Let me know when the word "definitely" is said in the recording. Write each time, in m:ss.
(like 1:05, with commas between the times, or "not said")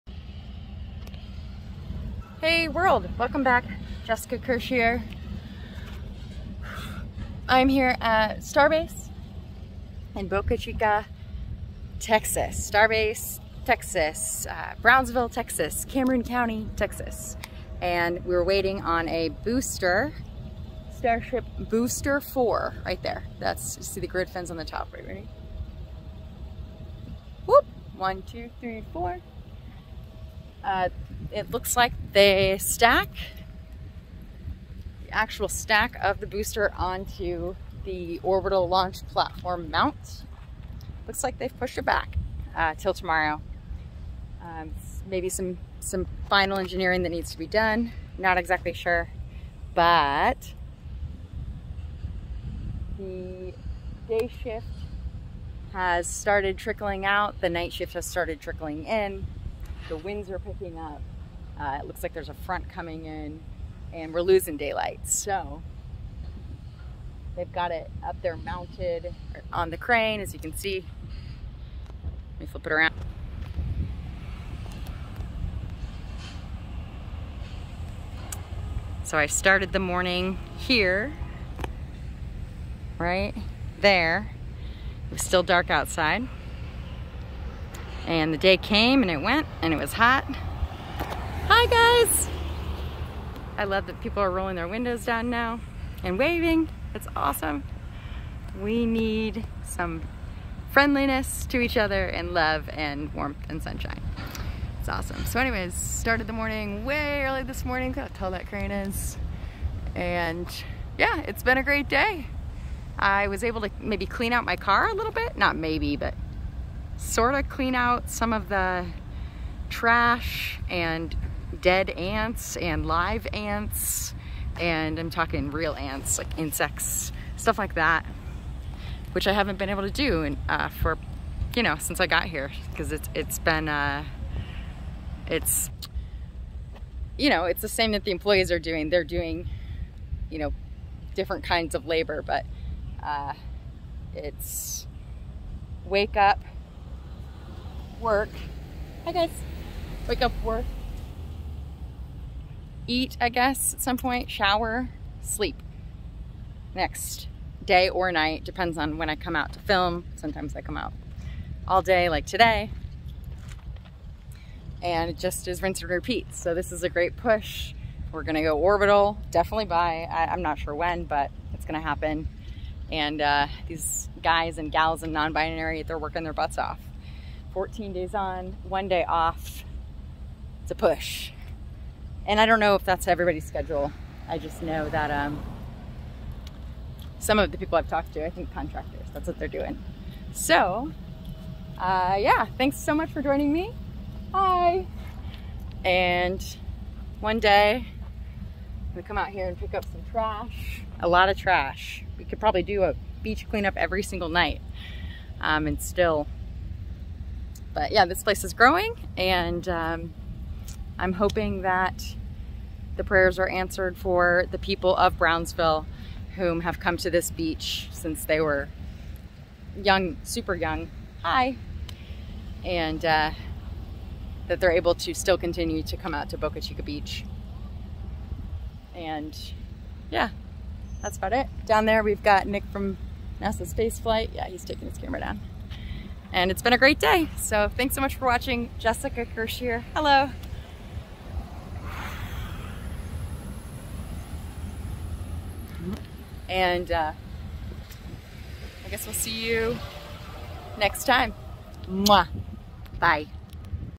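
2:49.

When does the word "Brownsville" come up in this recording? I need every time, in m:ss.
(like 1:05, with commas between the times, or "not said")
0:14, 3:35.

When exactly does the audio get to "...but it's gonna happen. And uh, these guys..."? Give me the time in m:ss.
2:51.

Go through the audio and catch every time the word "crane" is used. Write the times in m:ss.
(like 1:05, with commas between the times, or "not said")
1:09, 1:48.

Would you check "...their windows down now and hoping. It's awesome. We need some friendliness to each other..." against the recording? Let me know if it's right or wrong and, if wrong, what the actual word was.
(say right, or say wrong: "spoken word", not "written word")
wrong: "waving", not "hoping".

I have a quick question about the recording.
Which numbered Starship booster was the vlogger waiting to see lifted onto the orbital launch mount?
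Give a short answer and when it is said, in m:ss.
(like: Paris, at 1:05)
Booster 4, at 0:21.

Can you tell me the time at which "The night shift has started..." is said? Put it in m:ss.
0:57.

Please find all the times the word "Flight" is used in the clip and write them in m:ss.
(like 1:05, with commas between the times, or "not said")
3:53.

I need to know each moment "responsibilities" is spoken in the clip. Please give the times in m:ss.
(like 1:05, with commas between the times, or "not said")
not said.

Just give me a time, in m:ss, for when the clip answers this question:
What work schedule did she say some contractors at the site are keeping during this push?
2:57.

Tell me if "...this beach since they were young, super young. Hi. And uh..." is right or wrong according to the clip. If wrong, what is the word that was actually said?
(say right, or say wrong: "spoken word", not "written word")
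right.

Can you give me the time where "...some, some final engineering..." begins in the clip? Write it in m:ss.
0:45.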